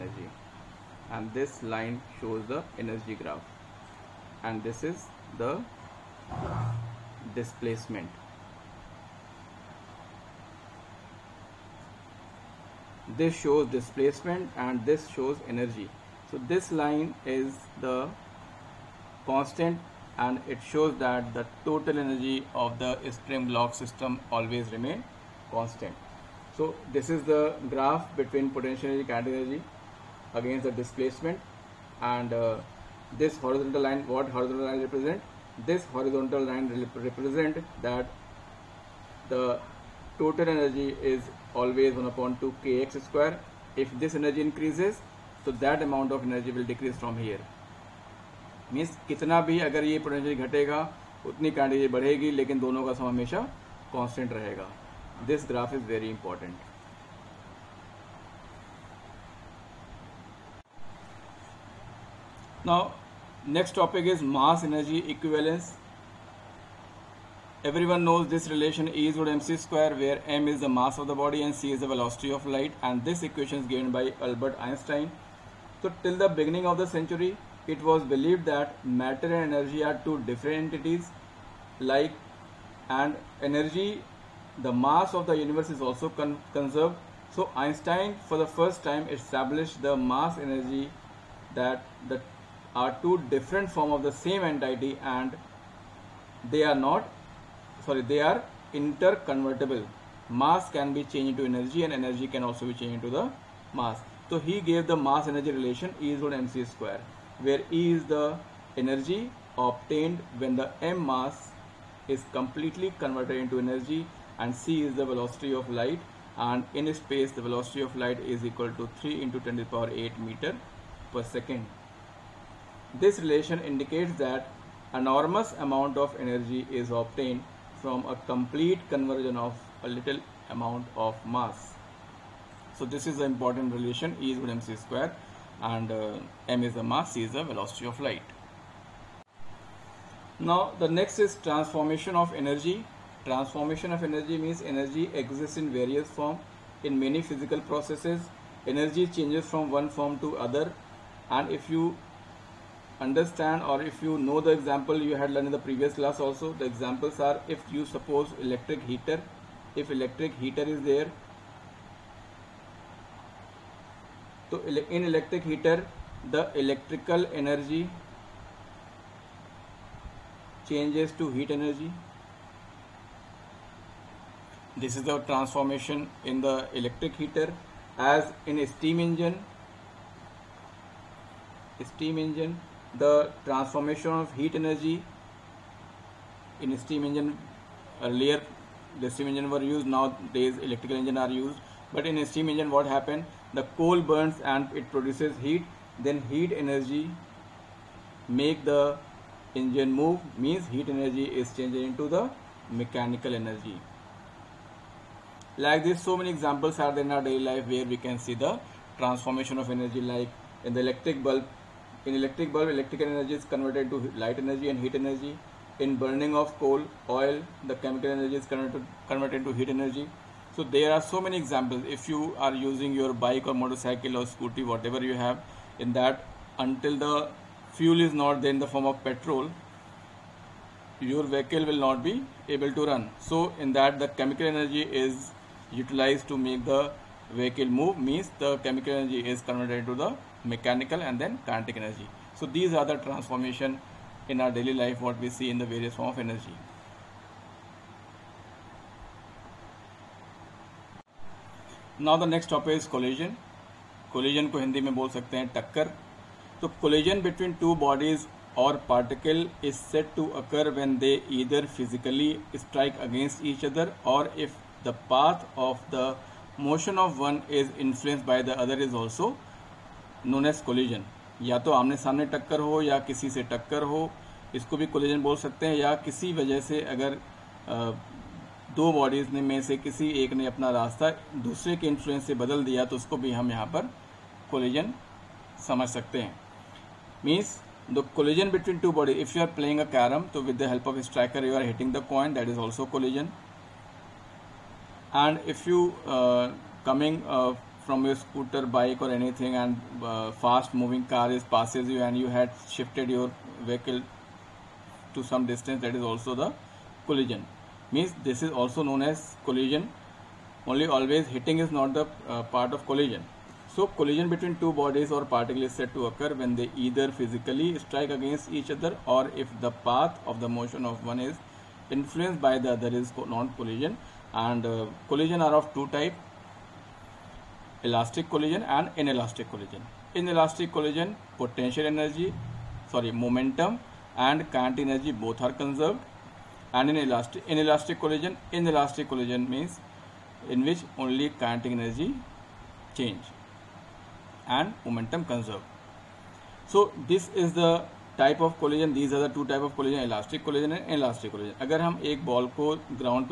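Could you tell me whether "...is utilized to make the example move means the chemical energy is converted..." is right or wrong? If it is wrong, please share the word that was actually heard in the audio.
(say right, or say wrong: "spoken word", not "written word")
wrong: "vehicle", not "example".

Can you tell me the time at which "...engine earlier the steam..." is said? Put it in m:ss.
3:07.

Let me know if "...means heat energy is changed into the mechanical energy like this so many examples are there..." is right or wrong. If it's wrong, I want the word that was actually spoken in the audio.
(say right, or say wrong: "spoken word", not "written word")
right.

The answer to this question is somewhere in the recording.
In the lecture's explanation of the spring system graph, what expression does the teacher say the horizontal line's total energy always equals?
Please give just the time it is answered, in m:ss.
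0:41.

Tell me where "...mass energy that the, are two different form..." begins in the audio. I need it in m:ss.
1:29.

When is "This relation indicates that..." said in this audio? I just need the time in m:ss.
2:03.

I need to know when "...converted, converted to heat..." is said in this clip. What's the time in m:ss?
3:38.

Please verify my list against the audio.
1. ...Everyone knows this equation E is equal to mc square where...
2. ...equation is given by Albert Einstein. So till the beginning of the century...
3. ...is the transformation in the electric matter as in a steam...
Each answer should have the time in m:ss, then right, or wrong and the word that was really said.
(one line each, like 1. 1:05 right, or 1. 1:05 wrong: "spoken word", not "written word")
1. 1:07 wrong: "relation", not "equation"
2. 1:13 right
3. 2:54 wrong: "heater", not "matter".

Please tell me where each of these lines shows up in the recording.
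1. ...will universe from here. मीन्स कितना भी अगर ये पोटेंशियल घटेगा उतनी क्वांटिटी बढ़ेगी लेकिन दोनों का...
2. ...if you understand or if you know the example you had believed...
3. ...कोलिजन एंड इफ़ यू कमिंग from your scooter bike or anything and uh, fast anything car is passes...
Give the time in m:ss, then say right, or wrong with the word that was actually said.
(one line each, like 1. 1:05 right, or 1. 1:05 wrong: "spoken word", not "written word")
1. 0:46 wrong: "decrease", not "universe"
2. 2:31 wrong: "learned", not "believed"
3. 4:52 wrong: "moving", not "anything".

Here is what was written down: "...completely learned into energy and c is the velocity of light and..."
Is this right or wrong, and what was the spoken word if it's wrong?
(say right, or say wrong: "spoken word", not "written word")
wrong: "converted", not "learned".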